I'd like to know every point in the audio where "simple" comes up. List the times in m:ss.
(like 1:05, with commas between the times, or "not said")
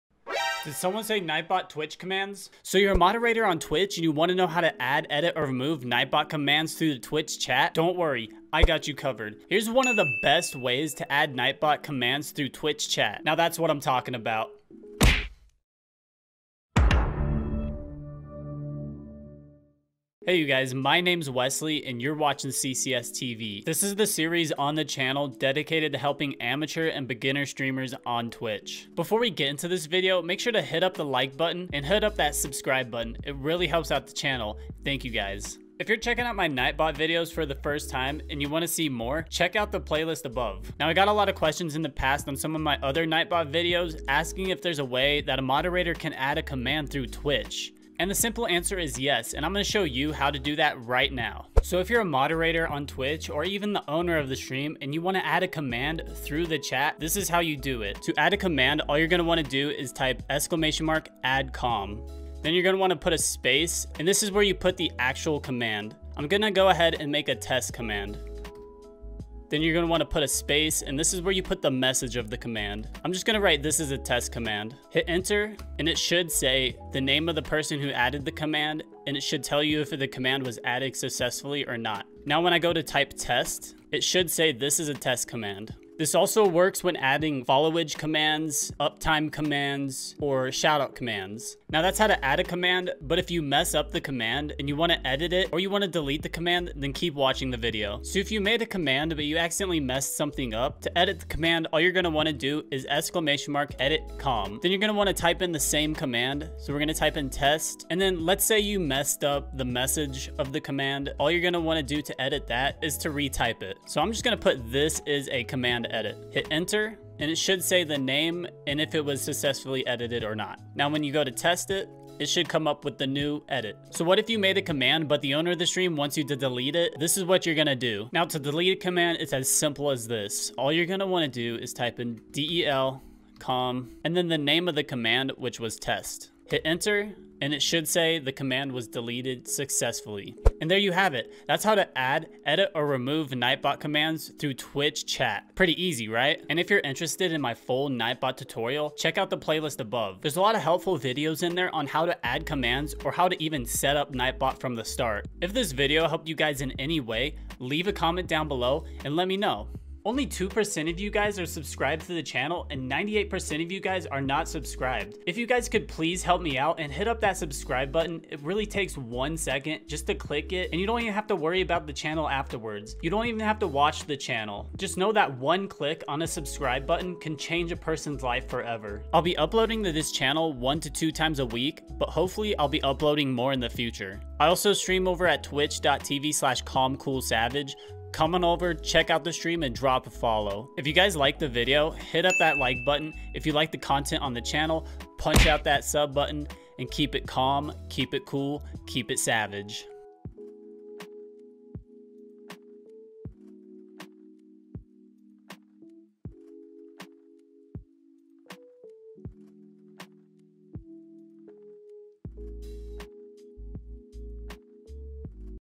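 0:48, 2:09.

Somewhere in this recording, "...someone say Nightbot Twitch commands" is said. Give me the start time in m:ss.
0:00.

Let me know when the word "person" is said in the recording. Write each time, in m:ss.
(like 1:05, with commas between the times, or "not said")
1:17, 2:57.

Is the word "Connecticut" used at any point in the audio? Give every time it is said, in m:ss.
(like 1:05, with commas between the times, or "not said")
not said.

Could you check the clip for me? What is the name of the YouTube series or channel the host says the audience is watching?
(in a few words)
CCS TV.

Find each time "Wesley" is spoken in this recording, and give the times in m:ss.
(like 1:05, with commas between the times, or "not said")
0:21.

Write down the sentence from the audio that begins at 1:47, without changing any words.
And then let's say you messed up the message of the command.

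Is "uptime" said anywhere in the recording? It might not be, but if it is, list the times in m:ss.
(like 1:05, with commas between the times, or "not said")
1:28.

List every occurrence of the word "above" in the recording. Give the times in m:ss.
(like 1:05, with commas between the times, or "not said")
0:40, 2:29.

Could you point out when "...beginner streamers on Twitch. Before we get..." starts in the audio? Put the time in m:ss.
0:27.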